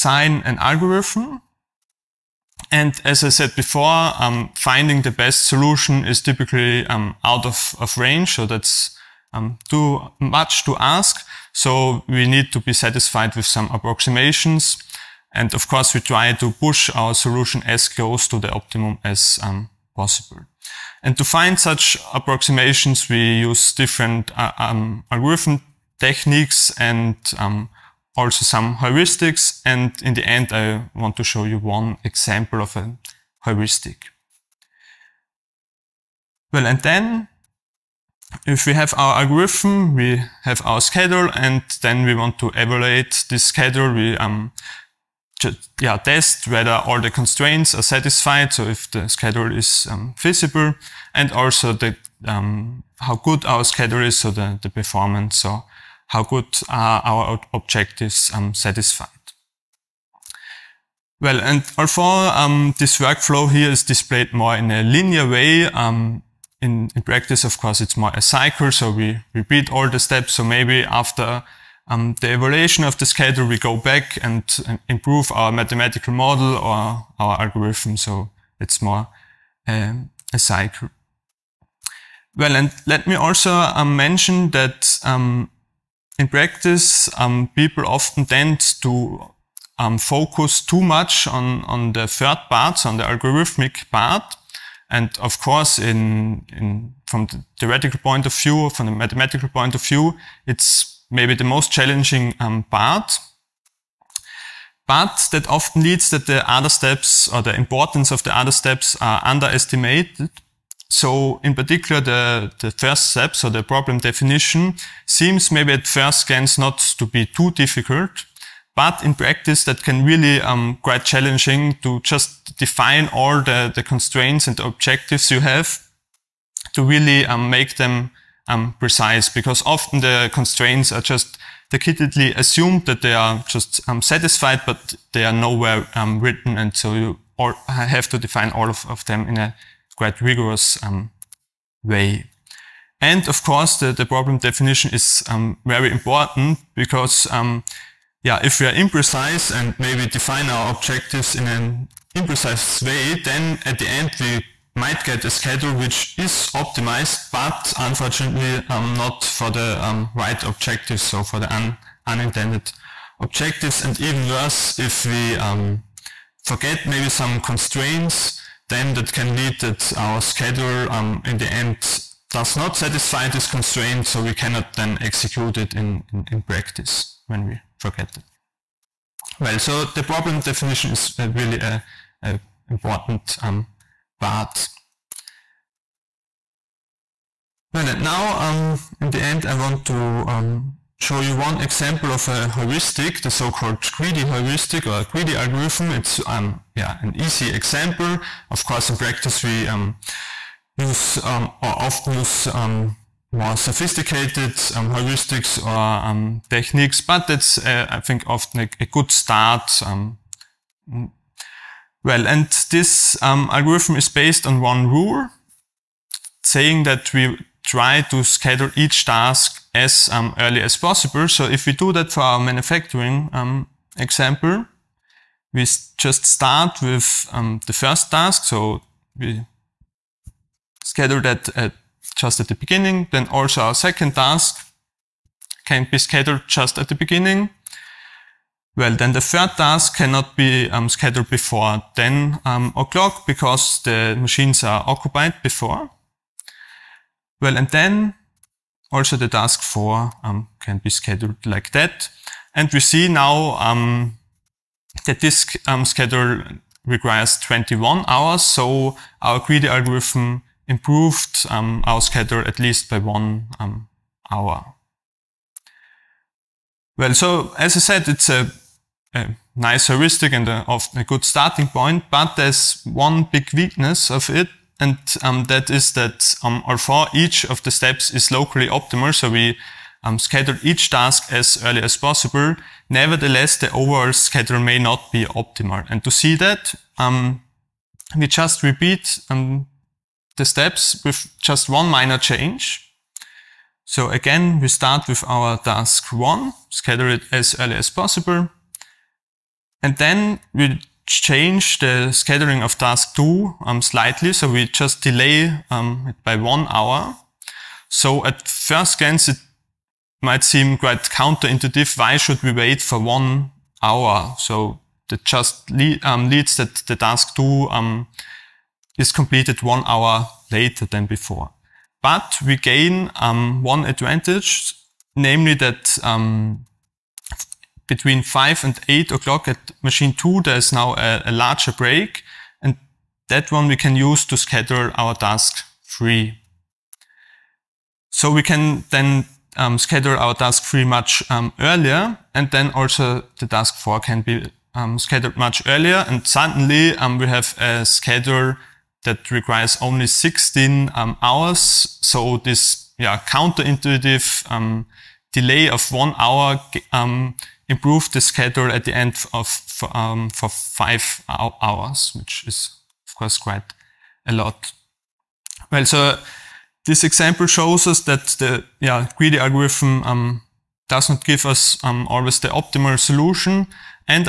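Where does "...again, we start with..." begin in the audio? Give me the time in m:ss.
4:54.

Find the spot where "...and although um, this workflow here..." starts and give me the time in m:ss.
1:01.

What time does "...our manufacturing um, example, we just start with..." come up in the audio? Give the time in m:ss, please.
3:42.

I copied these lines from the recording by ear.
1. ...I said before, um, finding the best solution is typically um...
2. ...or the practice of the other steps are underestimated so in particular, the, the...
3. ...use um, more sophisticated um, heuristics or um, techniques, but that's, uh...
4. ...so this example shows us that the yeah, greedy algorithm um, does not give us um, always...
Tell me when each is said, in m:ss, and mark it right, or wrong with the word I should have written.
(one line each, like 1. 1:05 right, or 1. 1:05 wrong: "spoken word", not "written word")
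1. 0:03 right
2. 1:47 wrong: "importance", not "practice"
3. 3:22 right
4. 6:05 right.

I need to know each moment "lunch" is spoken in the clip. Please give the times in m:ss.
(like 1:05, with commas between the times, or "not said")
not said.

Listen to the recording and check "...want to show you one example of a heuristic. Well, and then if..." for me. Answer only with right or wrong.
right.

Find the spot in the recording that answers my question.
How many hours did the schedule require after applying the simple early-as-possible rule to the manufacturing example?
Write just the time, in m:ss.
4:17.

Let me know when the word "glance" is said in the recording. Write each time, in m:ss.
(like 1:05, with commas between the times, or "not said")
1:56, 5:08.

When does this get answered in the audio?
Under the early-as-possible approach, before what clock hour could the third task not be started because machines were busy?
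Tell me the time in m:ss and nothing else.
4:01.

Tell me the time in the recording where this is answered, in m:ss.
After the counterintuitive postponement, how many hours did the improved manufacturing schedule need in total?
5:50.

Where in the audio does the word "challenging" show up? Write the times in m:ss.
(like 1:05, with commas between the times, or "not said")
1:41, 2:01.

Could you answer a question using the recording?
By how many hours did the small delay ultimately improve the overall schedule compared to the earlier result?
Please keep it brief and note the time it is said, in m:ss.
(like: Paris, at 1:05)
5, at 6:00.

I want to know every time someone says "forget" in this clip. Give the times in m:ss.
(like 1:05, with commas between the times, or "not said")
2:46, 2:57.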